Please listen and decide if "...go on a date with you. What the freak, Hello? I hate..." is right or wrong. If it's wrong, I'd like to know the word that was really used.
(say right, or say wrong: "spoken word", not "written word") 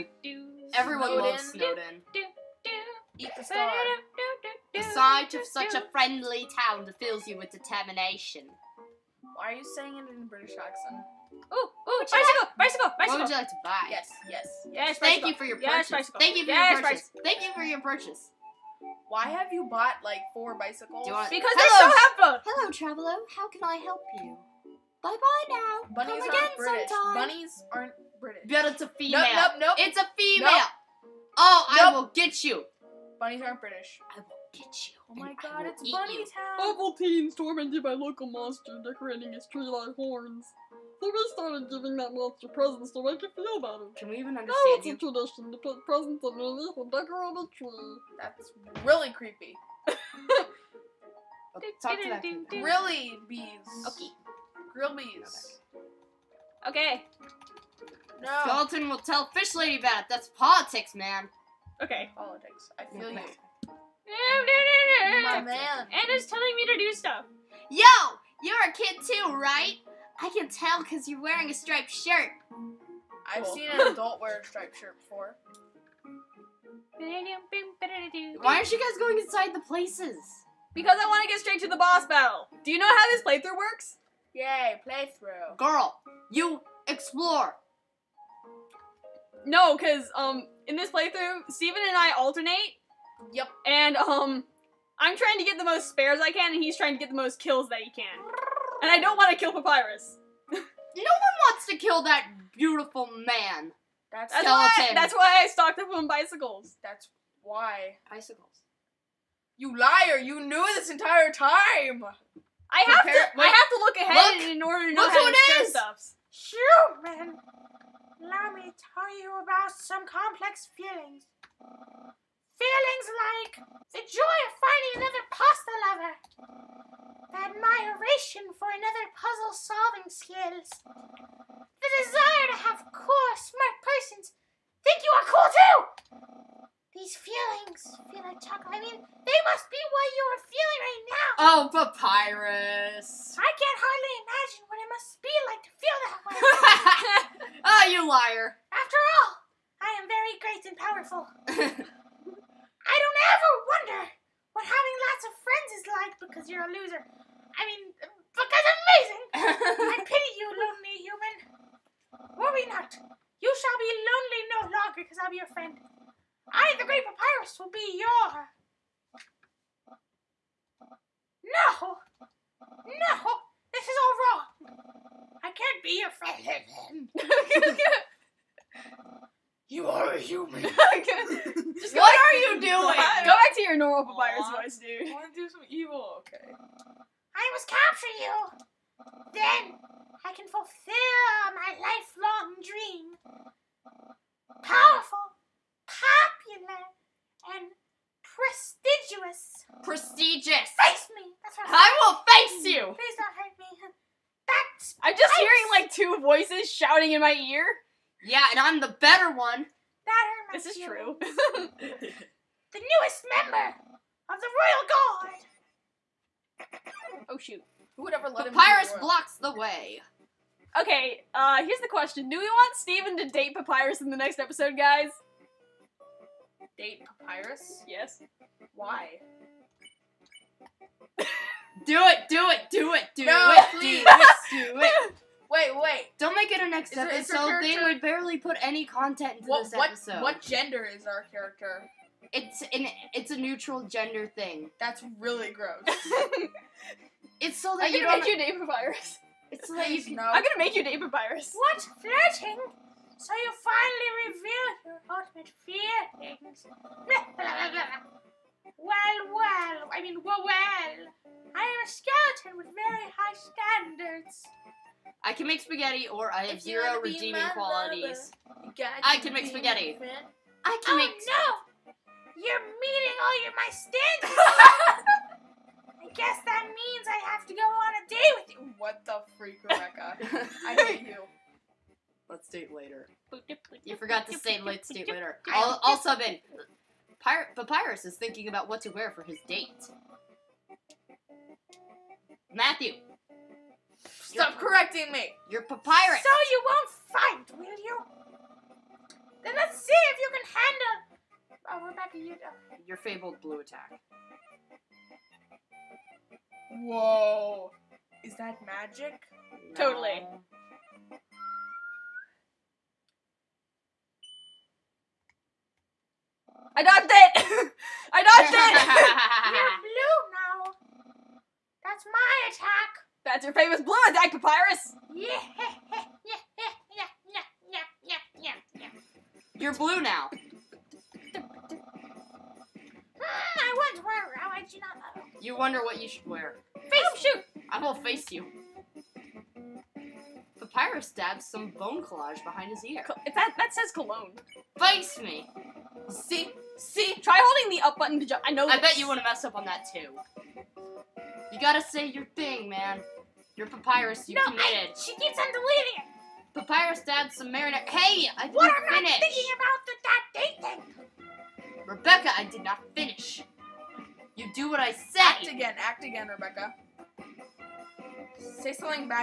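wrong: "Rebecca", not "Hello".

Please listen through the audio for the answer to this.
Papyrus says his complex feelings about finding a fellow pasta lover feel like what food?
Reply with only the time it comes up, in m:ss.
2:18.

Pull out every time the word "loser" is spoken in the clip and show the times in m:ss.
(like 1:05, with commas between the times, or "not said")
2:36.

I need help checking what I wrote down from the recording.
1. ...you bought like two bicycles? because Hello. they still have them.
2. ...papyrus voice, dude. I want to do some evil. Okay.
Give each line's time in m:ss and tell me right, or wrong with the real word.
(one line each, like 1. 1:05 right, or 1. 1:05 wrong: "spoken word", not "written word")
1. 0:19 wrong: "four", not "two"
2. 3:04 right.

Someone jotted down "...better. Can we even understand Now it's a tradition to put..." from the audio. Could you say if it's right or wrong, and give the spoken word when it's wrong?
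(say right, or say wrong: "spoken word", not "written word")
right.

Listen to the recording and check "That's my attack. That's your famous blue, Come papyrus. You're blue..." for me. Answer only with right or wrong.
wrong.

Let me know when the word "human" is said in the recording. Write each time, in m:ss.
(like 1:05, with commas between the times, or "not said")
1:56, 2:41, 3:00.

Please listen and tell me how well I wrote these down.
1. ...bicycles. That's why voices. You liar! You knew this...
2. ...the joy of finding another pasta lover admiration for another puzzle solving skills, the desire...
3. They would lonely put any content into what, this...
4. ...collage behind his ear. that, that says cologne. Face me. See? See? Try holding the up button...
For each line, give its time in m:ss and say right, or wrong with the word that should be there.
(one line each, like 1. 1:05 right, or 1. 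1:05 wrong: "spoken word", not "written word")
1. 1:46 wrong: "bicycles", not "voices"
2. 2:03 right
3. 3:57 wrong: "barely", not "lonely"
4. 5:42 right.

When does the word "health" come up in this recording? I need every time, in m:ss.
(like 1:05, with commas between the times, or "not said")
not said.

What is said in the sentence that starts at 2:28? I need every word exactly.
After all, I am very great and powerful.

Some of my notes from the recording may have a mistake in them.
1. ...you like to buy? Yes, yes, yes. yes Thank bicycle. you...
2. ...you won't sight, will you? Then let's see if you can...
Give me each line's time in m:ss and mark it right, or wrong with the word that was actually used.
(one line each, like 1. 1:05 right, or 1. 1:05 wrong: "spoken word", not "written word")
1. 0:13 right
2. 4:56 wrong: "fight", not "sight".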